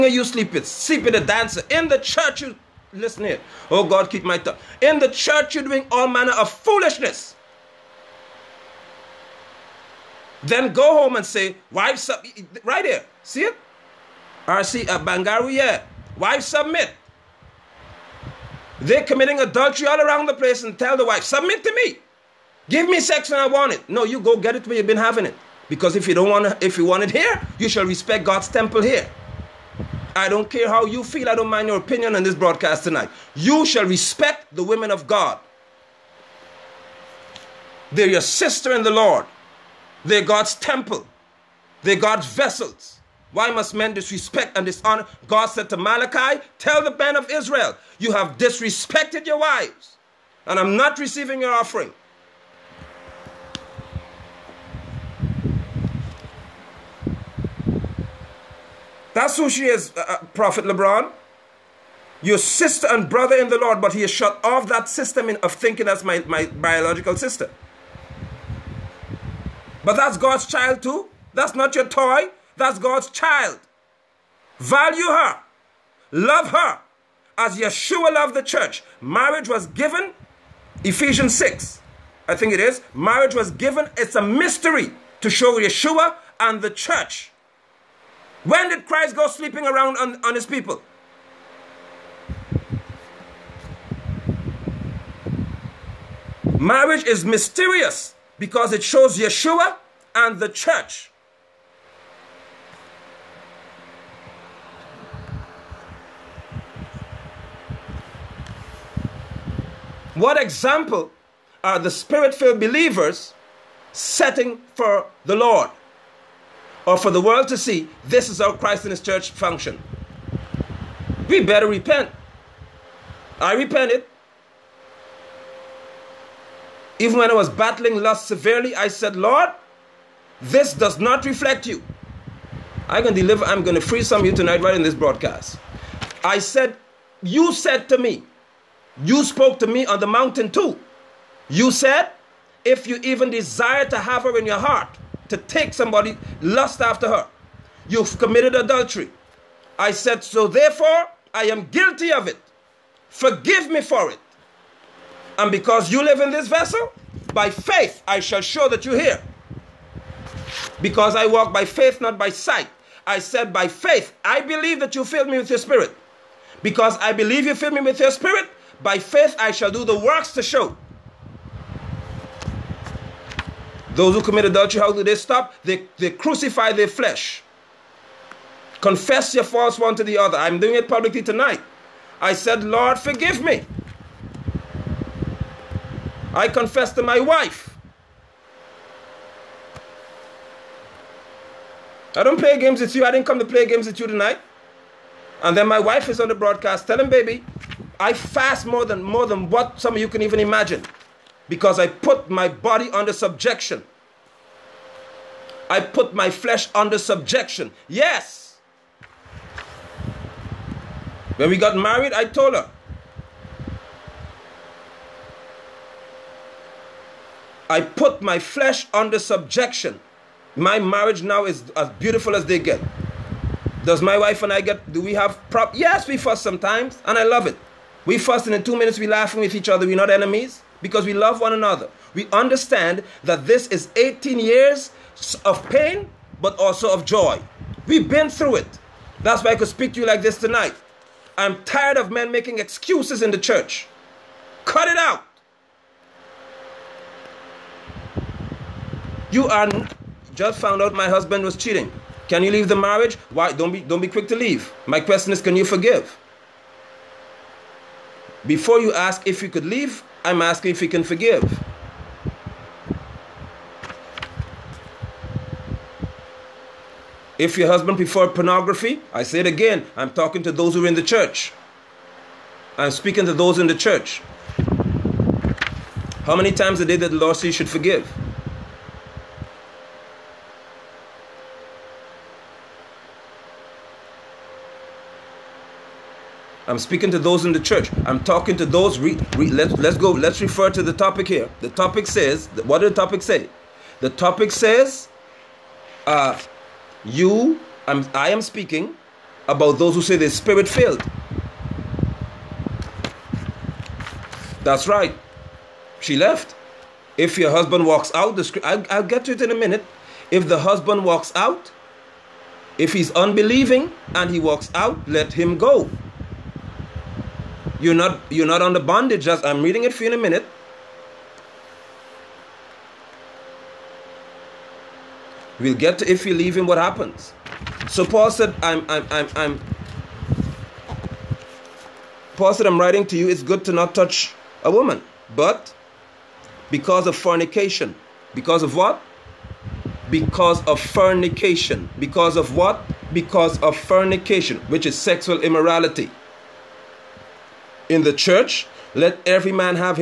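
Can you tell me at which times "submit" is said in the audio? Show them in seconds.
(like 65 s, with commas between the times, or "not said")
16 s, 21 s.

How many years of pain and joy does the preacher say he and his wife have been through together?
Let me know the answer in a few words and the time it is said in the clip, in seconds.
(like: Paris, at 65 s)
18, at 233 s.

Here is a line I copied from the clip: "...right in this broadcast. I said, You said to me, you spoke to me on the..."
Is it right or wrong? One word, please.
right.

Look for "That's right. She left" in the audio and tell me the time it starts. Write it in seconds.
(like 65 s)
304 s.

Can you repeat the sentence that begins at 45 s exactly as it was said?
God said to Malachi, Tell the band of Israel, you have disrespected your wives, and I'm not receiving your offering.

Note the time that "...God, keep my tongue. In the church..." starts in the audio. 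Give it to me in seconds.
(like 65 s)
3 s.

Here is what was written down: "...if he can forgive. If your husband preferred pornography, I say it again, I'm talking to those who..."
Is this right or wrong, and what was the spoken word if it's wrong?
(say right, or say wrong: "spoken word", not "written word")
right.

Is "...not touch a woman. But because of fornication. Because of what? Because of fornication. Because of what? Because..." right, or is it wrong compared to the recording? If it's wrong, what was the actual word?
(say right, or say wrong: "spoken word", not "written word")
right.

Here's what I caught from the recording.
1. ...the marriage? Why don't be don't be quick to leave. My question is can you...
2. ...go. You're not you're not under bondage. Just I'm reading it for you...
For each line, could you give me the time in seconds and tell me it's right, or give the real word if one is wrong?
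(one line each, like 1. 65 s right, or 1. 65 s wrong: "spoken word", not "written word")
1. 252 s right
2. 315 s right.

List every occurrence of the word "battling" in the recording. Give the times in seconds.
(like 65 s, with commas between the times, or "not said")
127 s.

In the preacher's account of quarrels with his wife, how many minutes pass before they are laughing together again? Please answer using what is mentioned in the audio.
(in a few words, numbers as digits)
2.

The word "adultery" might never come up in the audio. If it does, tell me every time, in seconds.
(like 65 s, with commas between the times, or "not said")
19 s, 148 s, 174 s.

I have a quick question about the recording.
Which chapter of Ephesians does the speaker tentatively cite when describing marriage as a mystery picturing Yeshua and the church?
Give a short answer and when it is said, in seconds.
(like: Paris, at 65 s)
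6, at 80 s.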